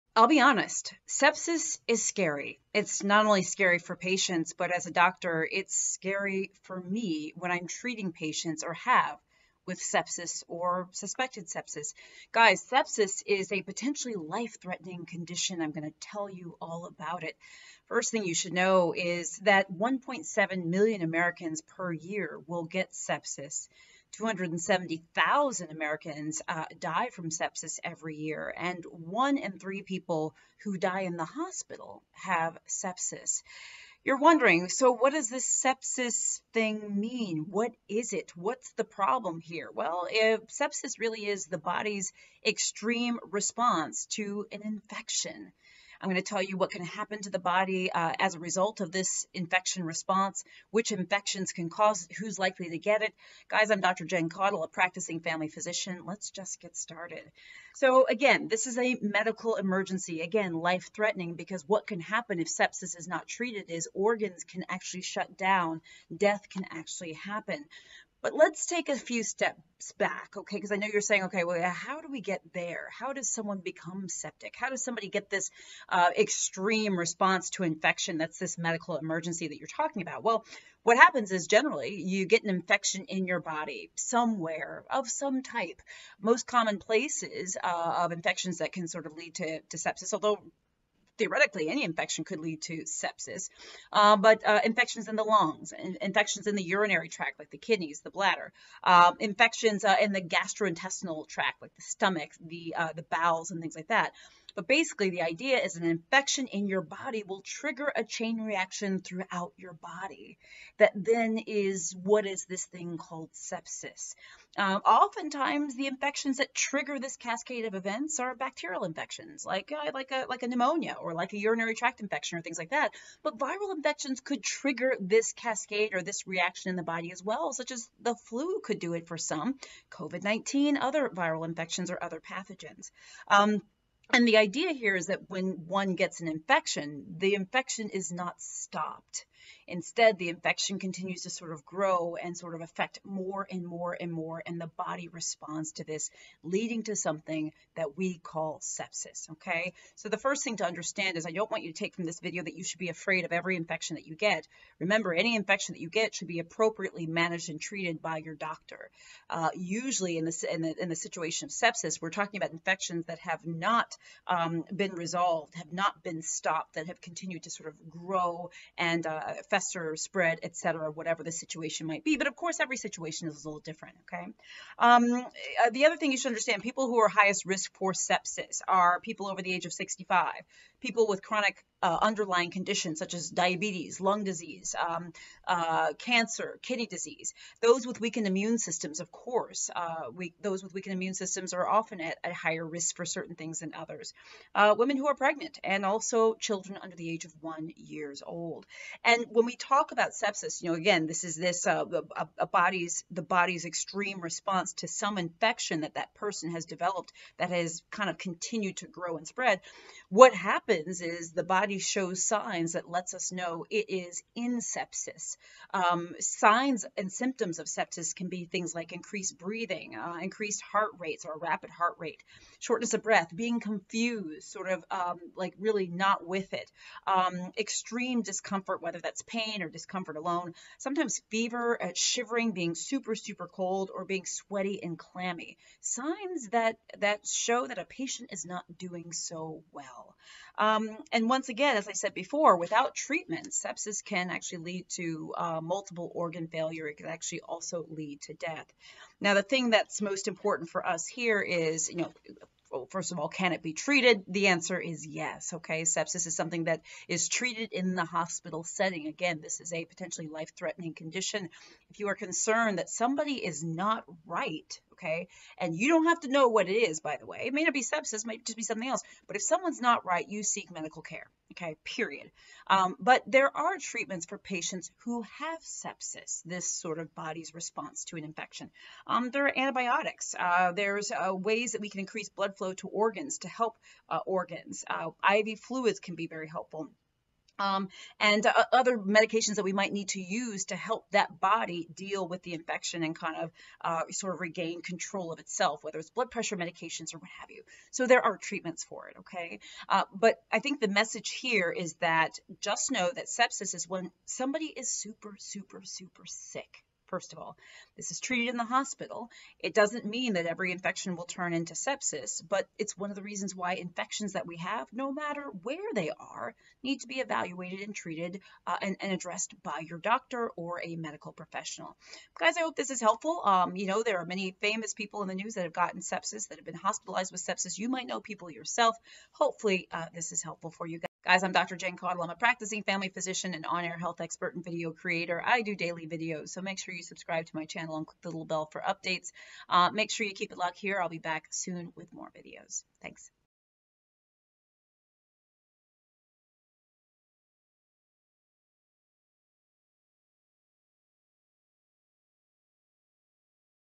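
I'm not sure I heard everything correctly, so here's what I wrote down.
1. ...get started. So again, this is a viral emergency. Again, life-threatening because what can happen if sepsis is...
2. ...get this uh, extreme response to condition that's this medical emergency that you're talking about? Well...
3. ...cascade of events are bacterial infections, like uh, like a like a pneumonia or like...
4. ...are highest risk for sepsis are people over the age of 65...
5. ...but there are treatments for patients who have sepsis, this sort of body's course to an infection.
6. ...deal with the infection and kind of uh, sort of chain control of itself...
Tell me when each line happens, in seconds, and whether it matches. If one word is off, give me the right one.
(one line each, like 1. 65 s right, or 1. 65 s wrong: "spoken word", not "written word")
1. 56 s wrong: "medical", not "viral"
2. 75 s wrong: "infection", not "condition"
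3. 117 s right
4. 176 s right
5. 272 s wrong: "response", not "course"
6. 291 s wrong: "regain", not "chain".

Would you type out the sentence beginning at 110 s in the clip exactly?
That then is what is this thing called sepsis.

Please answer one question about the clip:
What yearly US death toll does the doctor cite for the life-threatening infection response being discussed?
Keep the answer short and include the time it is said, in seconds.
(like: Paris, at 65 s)
270,000, at 24 s.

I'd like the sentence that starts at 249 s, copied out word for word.
Now, the thing that's most important for us here is, you know, well, first of all, can it be treated?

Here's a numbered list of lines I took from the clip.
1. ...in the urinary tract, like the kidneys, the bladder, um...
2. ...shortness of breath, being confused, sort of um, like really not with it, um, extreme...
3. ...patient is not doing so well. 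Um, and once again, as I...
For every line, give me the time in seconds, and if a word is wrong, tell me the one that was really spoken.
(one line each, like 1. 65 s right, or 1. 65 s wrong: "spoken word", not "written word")
1. 96 s right
2. 222 s right
3. 237 s right.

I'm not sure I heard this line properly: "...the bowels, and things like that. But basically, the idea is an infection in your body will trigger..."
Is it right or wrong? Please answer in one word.
right.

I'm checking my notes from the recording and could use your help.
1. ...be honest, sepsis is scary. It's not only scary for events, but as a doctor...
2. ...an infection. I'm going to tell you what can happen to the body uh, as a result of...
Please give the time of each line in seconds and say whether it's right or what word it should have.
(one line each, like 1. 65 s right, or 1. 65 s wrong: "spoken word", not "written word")
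1. 0 s wrong: "patients", not "events"
2. 44 s right.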